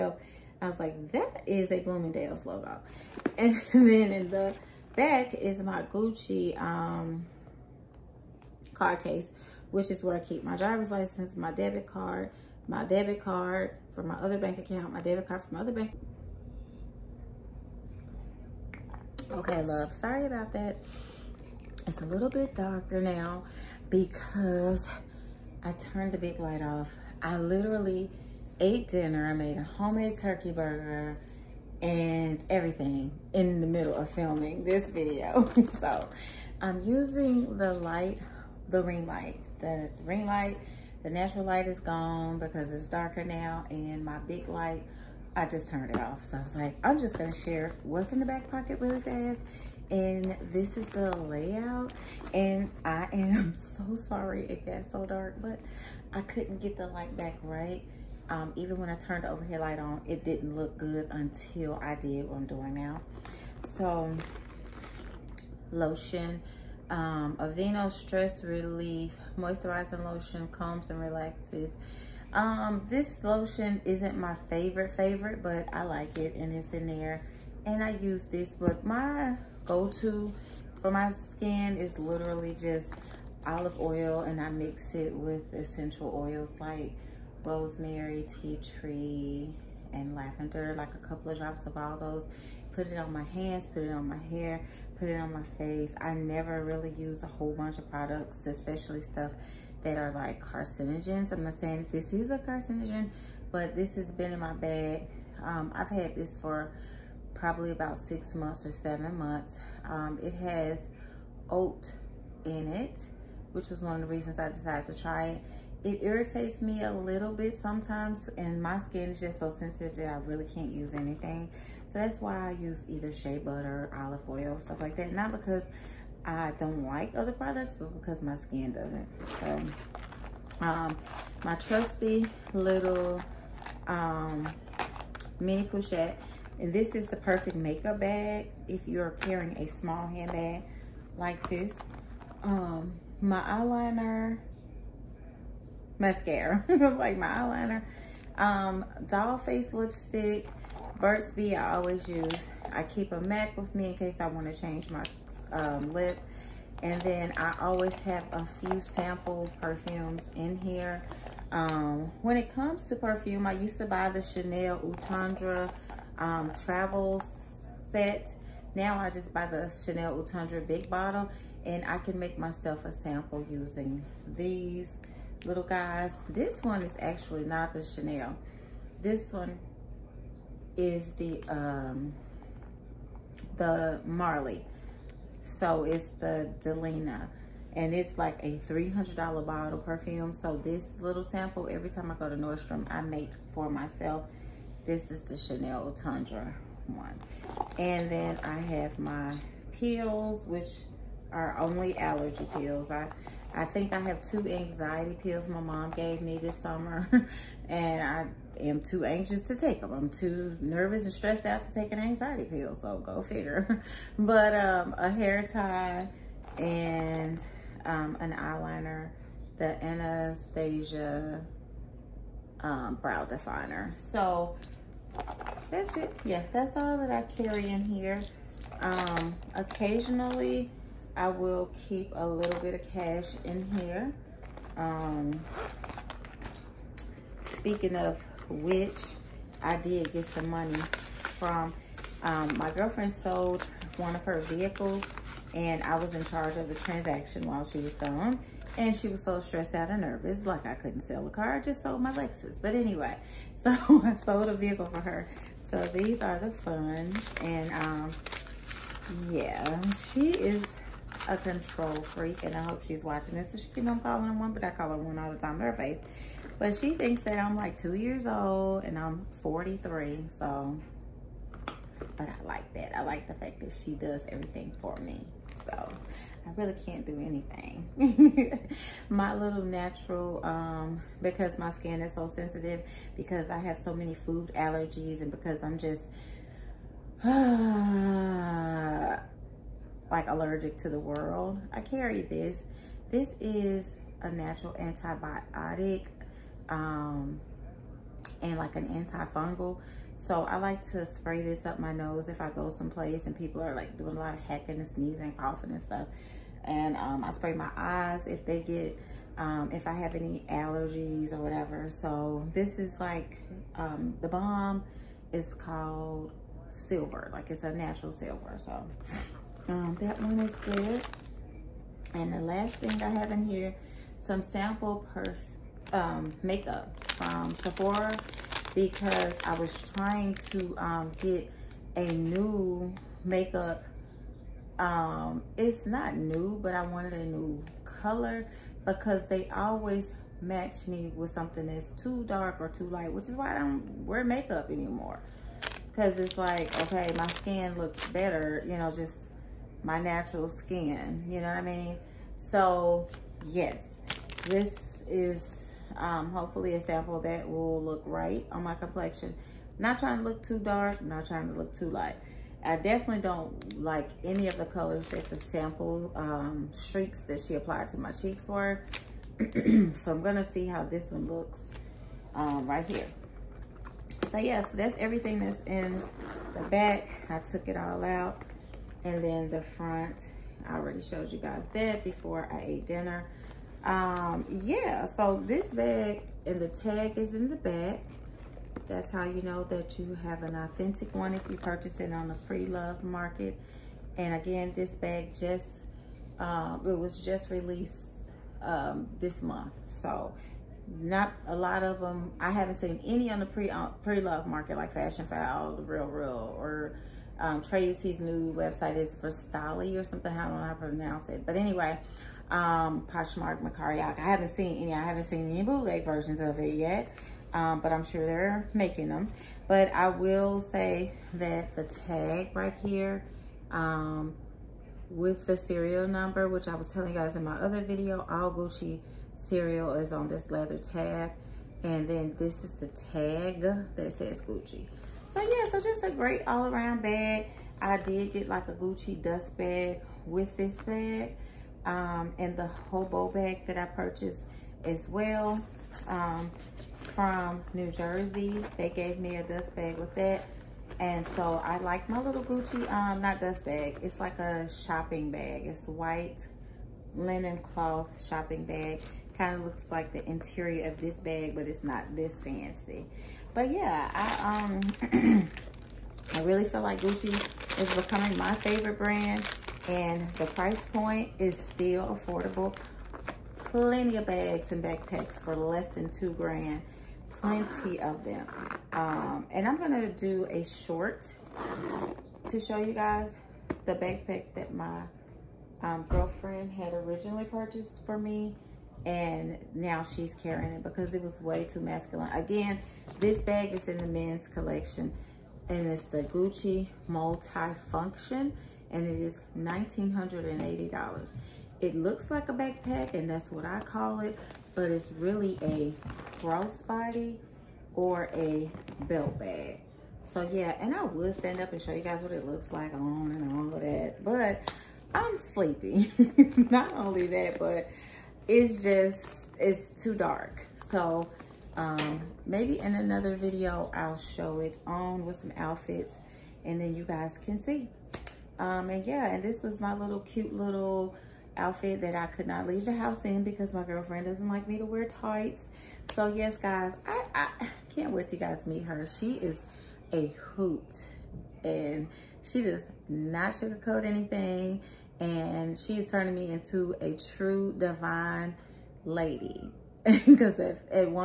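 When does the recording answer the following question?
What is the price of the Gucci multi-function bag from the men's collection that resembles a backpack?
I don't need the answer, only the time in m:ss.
8:19.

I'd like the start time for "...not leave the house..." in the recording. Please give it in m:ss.
8:52.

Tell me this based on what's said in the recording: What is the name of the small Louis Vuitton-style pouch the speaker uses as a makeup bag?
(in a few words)
Mini pochette.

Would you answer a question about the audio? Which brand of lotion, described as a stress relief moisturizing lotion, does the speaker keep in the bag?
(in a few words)
Aveeno.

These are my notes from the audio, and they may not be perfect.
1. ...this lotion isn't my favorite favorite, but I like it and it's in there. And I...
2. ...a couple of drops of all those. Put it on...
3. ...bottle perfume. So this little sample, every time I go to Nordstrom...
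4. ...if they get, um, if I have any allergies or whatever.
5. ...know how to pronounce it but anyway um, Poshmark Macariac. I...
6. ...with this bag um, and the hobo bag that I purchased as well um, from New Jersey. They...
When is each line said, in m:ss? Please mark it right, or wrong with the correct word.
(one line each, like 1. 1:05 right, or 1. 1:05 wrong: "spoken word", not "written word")
1. 1:12 right
2. 1:30 right
3. 3:09 right
4. 5:08 right
5. 6:50 right
6. 7:20 right.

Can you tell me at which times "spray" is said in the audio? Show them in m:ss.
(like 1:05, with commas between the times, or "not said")
5:01, 5:07.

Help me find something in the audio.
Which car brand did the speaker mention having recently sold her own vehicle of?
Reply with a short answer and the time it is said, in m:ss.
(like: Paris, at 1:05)
Lexus, at 4:12.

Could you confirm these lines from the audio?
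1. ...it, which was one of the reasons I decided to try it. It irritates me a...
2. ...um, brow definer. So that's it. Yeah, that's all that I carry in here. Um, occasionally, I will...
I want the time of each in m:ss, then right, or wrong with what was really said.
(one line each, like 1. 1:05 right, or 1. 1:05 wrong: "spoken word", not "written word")
1. 1:52 right
2. 3:42 right.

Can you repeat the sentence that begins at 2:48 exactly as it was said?
Now I just buy the Chanel Eau Tendre big bottle and I can make myself a sample using these little guys.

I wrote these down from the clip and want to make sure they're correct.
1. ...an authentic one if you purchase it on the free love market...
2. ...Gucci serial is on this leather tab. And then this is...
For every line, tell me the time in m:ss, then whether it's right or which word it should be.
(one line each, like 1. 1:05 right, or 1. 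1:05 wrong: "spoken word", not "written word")
1. 6:30 right
2. 7:08 right.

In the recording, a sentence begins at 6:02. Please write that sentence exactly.
I definitely don't like any of the colors that the sample um, streaks that she applied to my cheeks were.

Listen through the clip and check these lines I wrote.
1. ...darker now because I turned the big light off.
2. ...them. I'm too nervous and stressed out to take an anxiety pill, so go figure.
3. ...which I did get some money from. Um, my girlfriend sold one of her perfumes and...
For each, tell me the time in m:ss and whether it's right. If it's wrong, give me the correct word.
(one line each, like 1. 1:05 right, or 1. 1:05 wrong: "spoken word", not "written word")
1. 0:22 right
2. 3:29 right
3. 3:58 wrong: "vehicles", not "perfumes".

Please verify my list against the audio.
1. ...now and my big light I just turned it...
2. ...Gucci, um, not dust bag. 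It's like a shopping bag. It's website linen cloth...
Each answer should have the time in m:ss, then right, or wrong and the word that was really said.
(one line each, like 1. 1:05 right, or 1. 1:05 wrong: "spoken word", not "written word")
1. 0:43 right
2. 7:32 wrong: "white", not "website".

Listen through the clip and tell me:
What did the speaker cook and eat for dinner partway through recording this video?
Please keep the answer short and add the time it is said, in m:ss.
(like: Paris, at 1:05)
Homemade turkey burger, at 0:29.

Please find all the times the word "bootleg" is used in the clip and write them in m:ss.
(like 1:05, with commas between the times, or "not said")
6:55.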